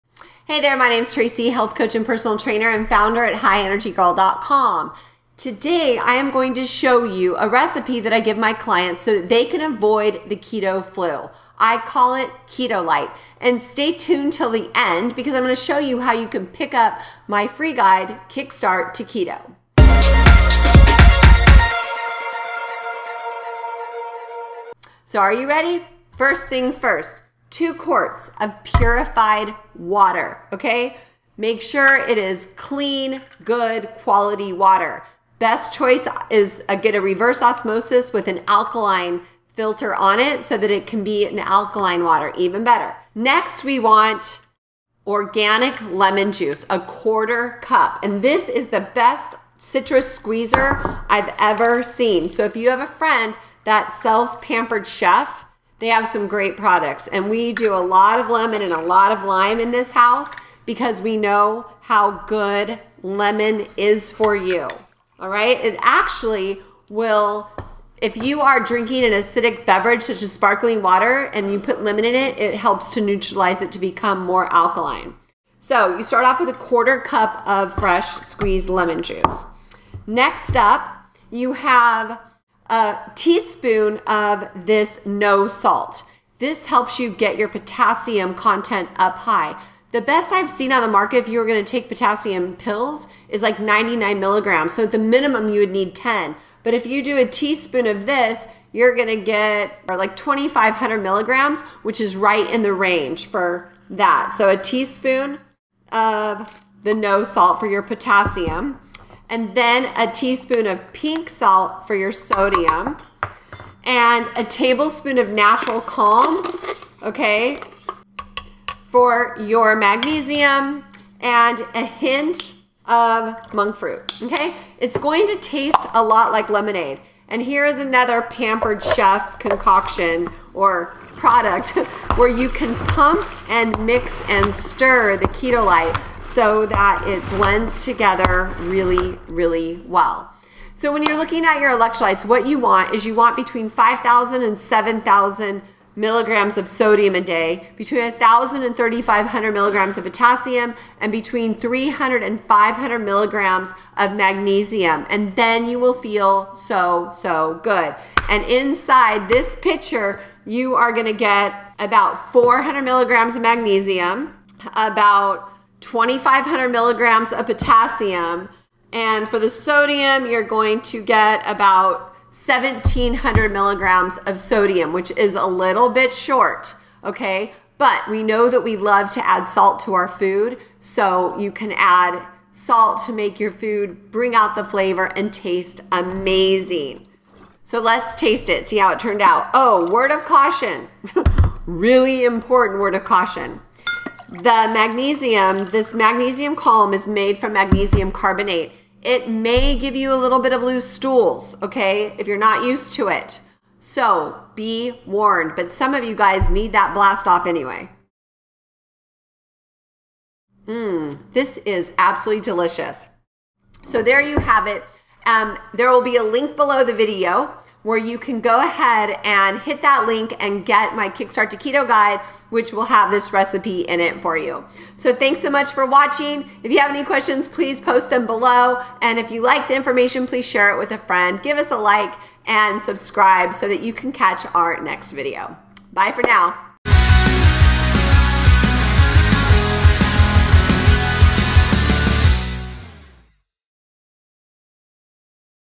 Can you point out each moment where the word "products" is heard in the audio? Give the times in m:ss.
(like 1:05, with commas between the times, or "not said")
0:56, 2:11.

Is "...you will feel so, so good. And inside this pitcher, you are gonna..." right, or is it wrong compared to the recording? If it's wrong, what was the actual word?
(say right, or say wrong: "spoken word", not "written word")
right.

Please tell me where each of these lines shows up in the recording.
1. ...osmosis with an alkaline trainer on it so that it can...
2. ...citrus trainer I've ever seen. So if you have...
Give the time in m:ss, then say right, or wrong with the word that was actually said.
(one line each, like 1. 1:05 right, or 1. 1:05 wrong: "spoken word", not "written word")
1. 0:37 wrong: "filter", not "trainer"
2. 0:49 wrong: "squeezer", not "trainer".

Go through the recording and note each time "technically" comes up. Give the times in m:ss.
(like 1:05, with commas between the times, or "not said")
not said.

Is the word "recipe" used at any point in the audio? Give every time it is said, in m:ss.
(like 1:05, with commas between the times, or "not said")
0:07, 3:43.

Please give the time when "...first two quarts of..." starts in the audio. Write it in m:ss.
0:26.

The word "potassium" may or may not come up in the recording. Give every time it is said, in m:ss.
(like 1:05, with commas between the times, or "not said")
1:27, 1:31, 1:47, 2:30, 2:47.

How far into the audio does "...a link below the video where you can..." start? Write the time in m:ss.
3:36.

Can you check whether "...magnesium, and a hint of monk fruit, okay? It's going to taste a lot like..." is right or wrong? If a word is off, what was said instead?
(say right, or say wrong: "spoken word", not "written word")
right.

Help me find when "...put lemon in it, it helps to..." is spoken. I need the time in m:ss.
1:11.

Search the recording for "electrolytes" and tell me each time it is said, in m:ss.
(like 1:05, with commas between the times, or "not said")
2:21.